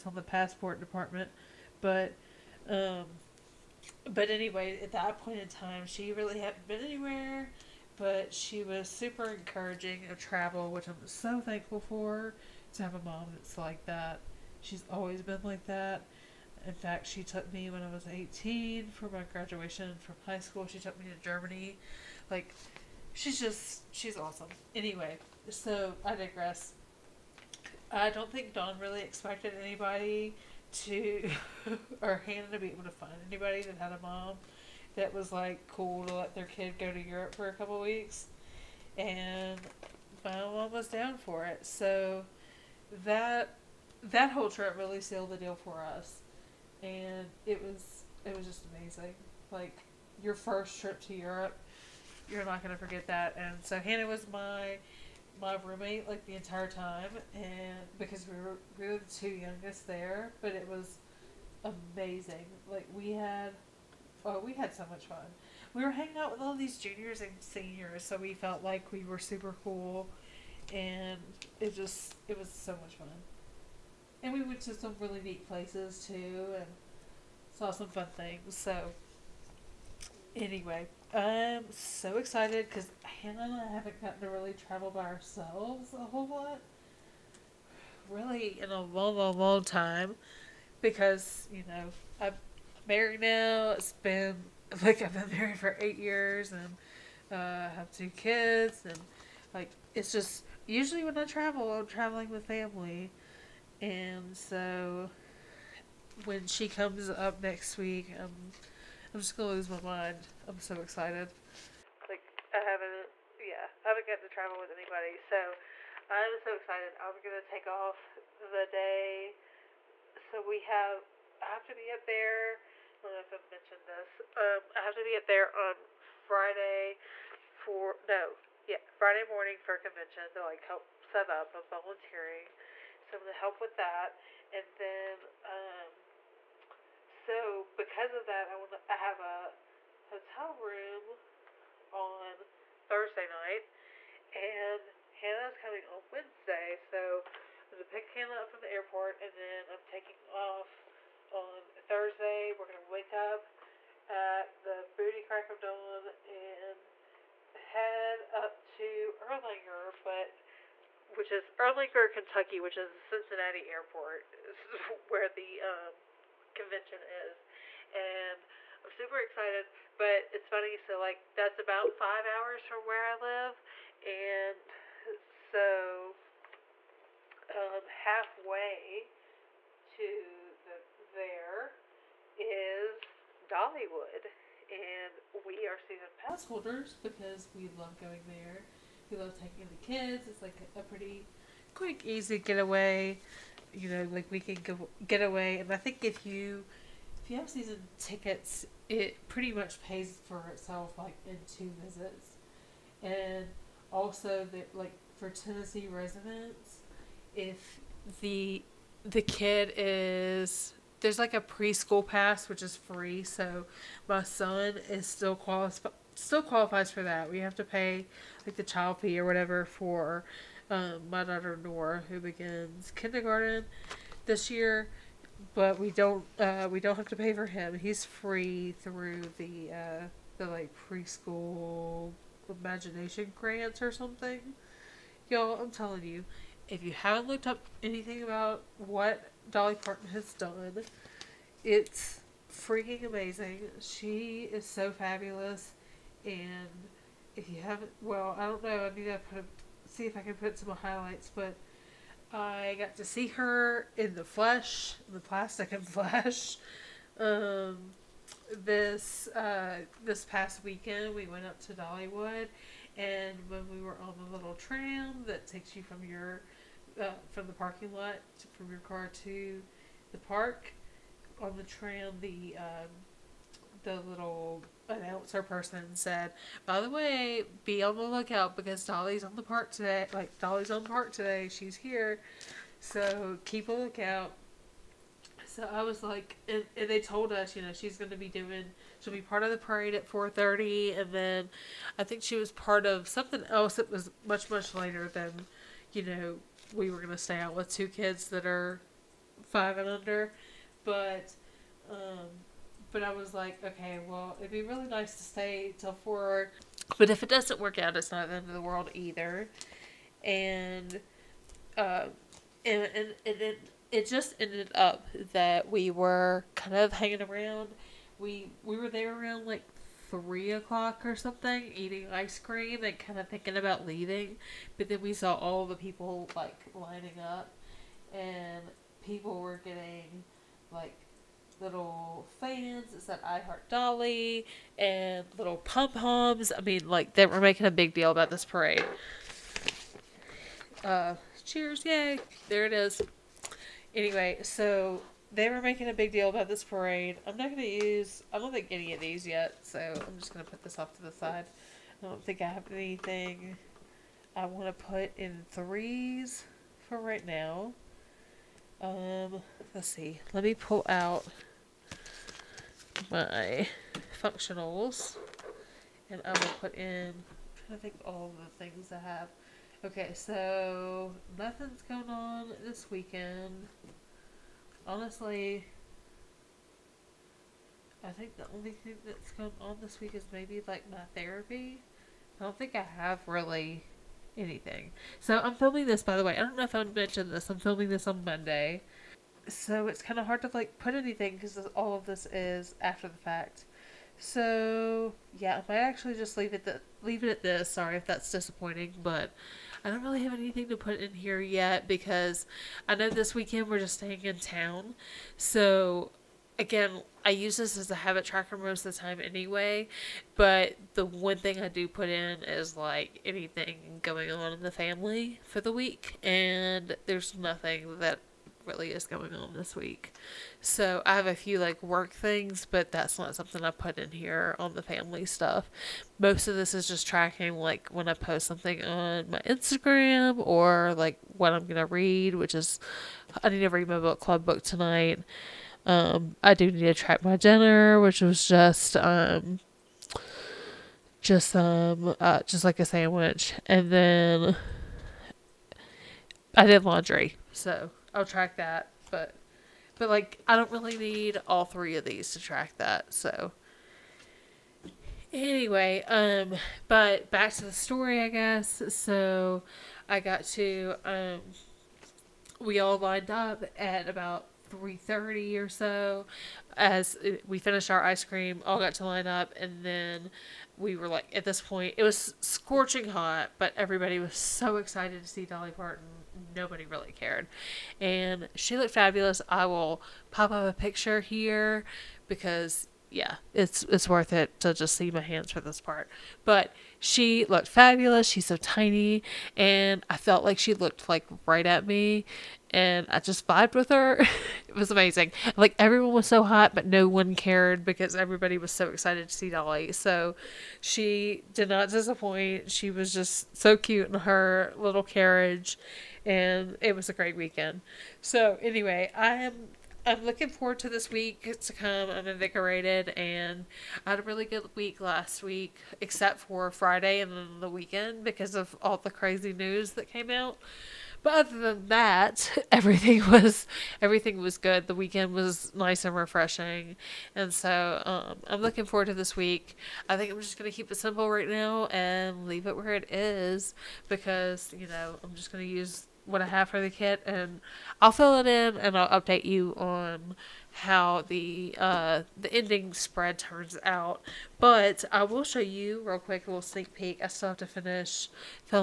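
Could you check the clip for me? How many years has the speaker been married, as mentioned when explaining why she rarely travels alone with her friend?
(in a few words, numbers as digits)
8.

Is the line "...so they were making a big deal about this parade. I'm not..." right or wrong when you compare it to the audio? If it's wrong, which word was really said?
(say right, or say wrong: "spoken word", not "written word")
right.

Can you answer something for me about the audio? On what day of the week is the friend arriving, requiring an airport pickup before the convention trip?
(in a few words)
Wednesday.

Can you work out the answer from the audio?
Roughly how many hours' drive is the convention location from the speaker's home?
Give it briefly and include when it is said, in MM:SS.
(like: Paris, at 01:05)
5 hours, at 02:51.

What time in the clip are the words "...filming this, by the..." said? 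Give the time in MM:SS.
06:25.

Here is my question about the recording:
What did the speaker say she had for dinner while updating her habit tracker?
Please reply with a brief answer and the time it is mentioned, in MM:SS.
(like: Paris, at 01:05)
A sandwich, at 07:22.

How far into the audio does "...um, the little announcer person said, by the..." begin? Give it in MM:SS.
04:32.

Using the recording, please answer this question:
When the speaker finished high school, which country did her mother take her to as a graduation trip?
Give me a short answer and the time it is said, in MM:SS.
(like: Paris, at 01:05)
Germany, at 00:21.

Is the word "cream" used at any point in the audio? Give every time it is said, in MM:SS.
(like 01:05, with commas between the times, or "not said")
05:22, 07:48.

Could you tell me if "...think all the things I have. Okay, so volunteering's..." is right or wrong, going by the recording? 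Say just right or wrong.
wrong.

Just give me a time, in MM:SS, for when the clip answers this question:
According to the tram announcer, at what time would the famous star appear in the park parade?
04:50.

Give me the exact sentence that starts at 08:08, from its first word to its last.
She's so tiny, and I felt like she looked like right at me, and I just vibed with her.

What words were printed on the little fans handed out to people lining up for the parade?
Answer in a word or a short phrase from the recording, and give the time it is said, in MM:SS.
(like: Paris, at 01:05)
I Heart Dolly, at 05:33.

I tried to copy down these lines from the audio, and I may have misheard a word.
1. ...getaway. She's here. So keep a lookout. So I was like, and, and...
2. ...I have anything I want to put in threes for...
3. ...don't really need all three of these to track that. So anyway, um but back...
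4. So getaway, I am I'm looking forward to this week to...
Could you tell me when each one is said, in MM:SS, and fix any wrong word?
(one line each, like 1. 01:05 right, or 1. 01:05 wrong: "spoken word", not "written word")
1. 04:41 wrong: "today", not "getaway"
2. 05:52 right
3. 07:30 right
4. 08:28 wrong: "anyway", not "getaway".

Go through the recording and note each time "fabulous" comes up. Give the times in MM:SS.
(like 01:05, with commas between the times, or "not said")
04:04, 07:58, 08:07.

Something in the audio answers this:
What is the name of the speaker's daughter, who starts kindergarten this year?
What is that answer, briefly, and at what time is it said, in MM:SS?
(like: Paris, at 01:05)
Nora, at 03:41.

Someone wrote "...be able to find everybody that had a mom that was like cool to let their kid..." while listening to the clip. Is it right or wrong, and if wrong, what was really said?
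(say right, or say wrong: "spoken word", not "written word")
wrong: "anybody", not "everybody".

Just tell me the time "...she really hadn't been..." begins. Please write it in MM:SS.
00:05.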